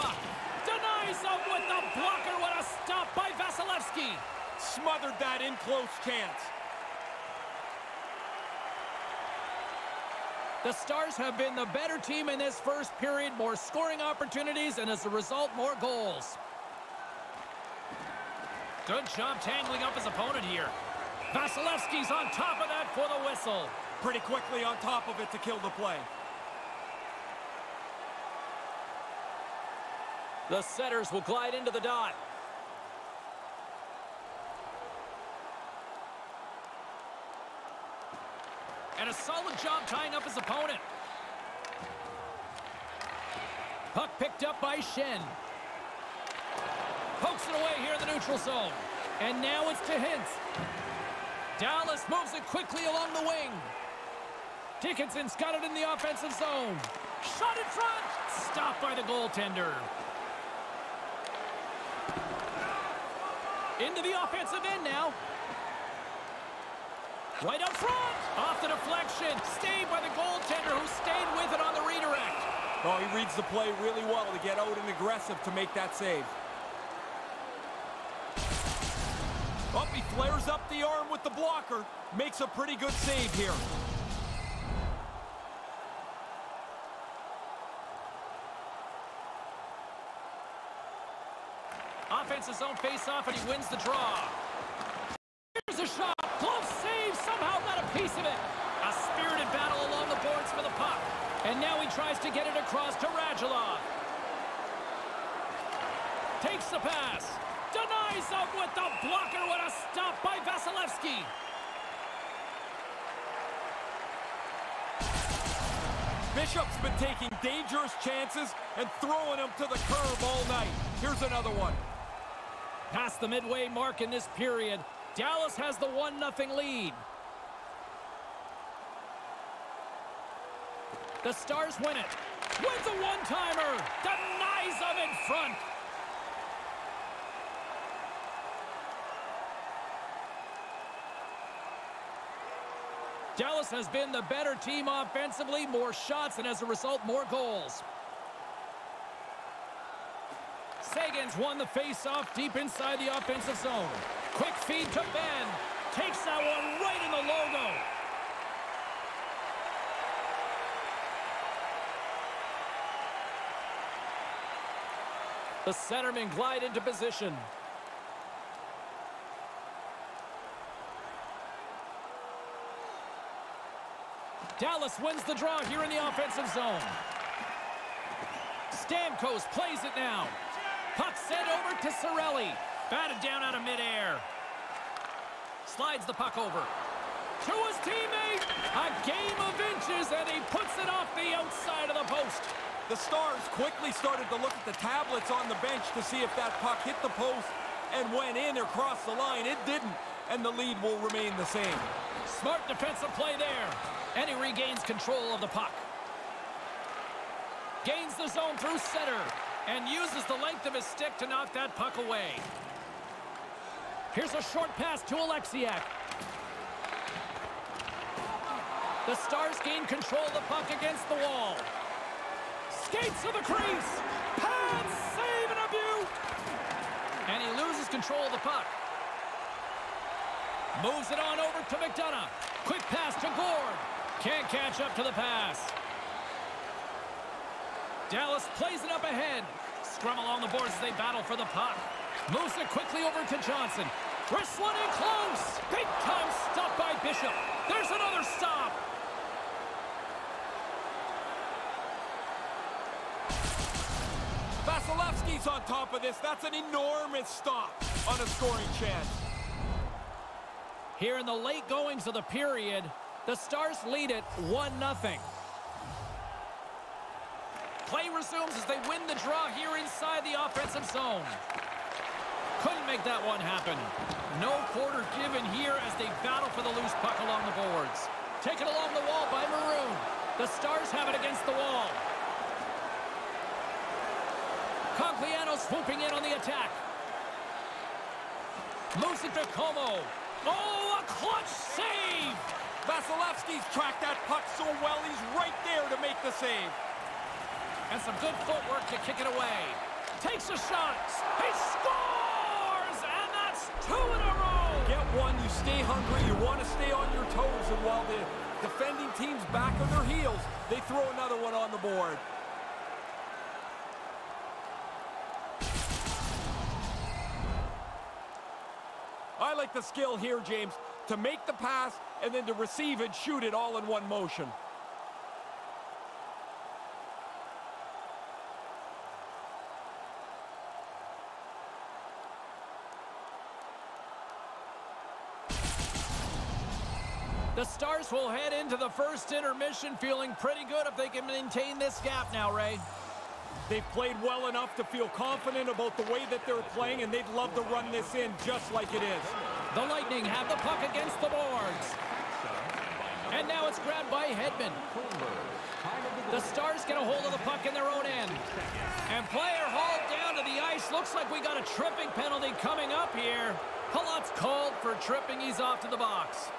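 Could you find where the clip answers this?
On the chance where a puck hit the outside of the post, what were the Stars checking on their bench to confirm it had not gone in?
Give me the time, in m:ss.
3:14.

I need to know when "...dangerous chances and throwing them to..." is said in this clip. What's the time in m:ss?
1:57.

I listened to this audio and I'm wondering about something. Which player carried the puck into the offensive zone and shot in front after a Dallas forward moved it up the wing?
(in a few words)
Dickinson.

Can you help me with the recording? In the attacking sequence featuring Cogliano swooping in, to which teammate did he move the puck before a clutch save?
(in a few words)
Comeau.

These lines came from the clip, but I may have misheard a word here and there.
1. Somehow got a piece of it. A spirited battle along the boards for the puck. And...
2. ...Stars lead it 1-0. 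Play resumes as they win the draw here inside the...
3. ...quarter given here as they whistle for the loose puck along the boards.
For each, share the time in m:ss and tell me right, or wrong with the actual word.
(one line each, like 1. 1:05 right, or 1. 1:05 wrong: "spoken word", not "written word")
1. 1:37 right
2. 4:23 right
3. 4:34 wrong: "battle", not "whistle".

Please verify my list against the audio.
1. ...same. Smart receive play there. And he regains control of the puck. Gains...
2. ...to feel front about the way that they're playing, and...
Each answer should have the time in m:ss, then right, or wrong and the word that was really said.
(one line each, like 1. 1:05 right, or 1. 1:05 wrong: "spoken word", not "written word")
1. 3:21 wrong: "defensive", not "receive"
2. 5:44 wrong: "confident", not "front".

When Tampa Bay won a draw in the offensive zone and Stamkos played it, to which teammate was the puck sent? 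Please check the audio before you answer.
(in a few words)
Cirelli.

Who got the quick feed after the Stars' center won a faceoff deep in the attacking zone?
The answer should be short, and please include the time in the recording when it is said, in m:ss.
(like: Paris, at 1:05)
Benn, at 2:35.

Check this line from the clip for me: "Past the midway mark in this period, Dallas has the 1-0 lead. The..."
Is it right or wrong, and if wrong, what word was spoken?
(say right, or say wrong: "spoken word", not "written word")
right.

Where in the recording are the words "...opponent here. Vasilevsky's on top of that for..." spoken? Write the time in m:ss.
0:20.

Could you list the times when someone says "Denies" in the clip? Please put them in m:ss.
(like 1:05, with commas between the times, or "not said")
0:00, 1:47, 2:14.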